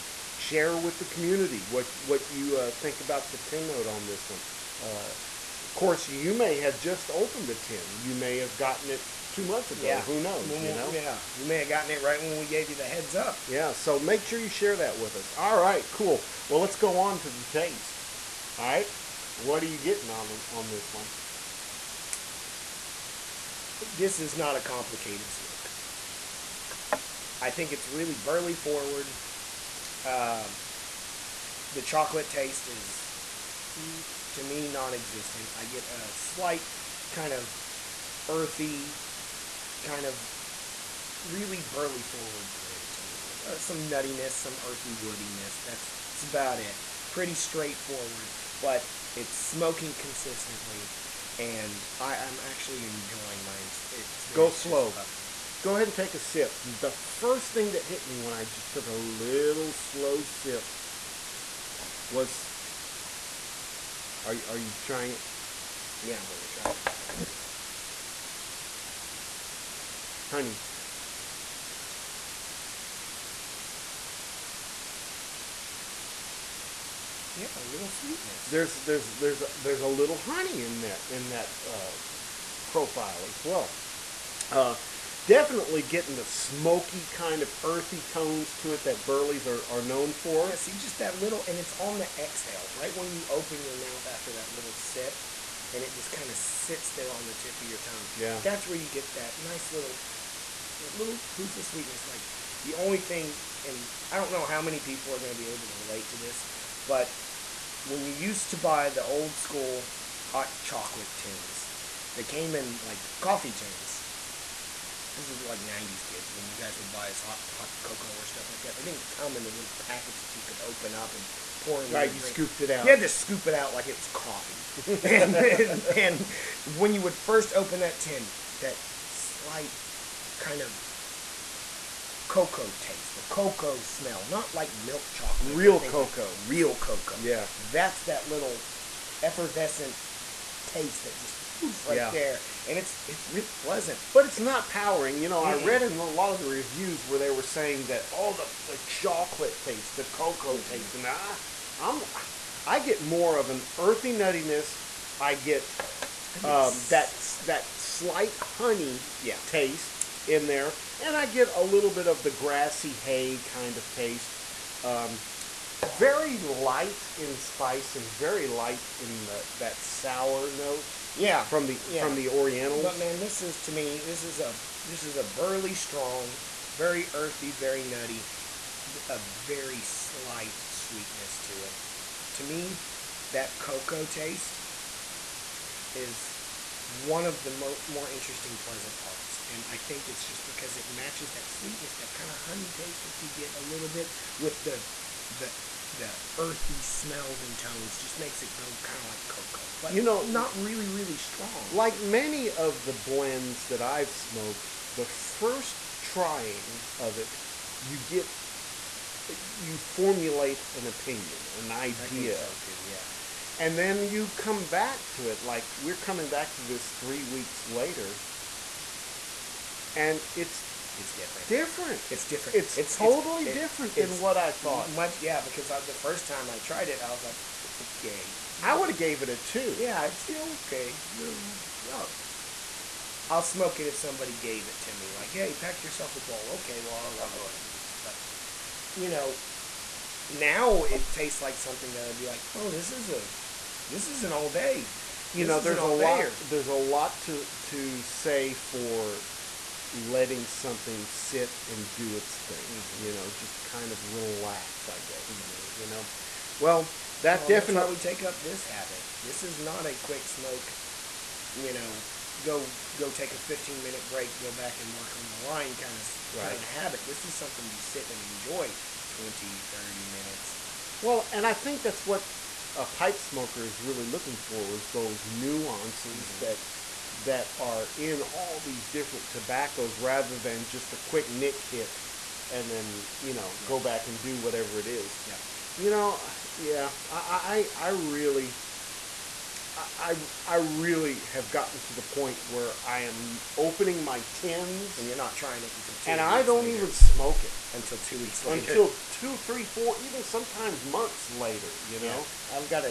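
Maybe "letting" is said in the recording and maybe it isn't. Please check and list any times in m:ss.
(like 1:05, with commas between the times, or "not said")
4:09.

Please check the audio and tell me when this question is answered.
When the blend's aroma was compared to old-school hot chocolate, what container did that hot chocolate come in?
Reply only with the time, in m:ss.
1:53.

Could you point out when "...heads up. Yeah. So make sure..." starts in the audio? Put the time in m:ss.
0:12.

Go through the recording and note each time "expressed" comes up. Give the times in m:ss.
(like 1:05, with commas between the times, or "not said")
not said.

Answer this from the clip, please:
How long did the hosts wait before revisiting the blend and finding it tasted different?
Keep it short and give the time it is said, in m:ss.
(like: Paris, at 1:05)
3 weeks, at 3:36.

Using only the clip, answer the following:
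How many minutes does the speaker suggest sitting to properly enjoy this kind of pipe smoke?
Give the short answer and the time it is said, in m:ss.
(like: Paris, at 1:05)
20 to 30 minutes, at 4:29.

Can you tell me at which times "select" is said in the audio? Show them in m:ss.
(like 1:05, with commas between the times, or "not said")
not said.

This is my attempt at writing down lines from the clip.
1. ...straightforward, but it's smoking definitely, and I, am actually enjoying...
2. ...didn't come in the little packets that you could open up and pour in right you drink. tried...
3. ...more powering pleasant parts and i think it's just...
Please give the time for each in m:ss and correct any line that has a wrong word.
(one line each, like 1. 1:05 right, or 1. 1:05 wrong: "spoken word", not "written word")
1. 0:47 wrong: "consistently", not "definitely"
2. 1:58 wrong: "scooped", not "tried"
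3. 3:07 wrong: "interesting", not "powering".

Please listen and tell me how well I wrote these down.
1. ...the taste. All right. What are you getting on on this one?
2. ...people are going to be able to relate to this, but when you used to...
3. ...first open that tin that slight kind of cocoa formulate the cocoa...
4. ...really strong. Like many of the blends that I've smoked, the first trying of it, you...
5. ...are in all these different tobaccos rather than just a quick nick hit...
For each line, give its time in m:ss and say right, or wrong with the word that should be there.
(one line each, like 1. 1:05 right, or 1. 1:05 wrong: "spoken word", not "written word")
1. 0:17 right
2. 1:44 right
3. 2:07 wrong: "taste", not "formulate"
4. 3:20 right
5. 4:37 right.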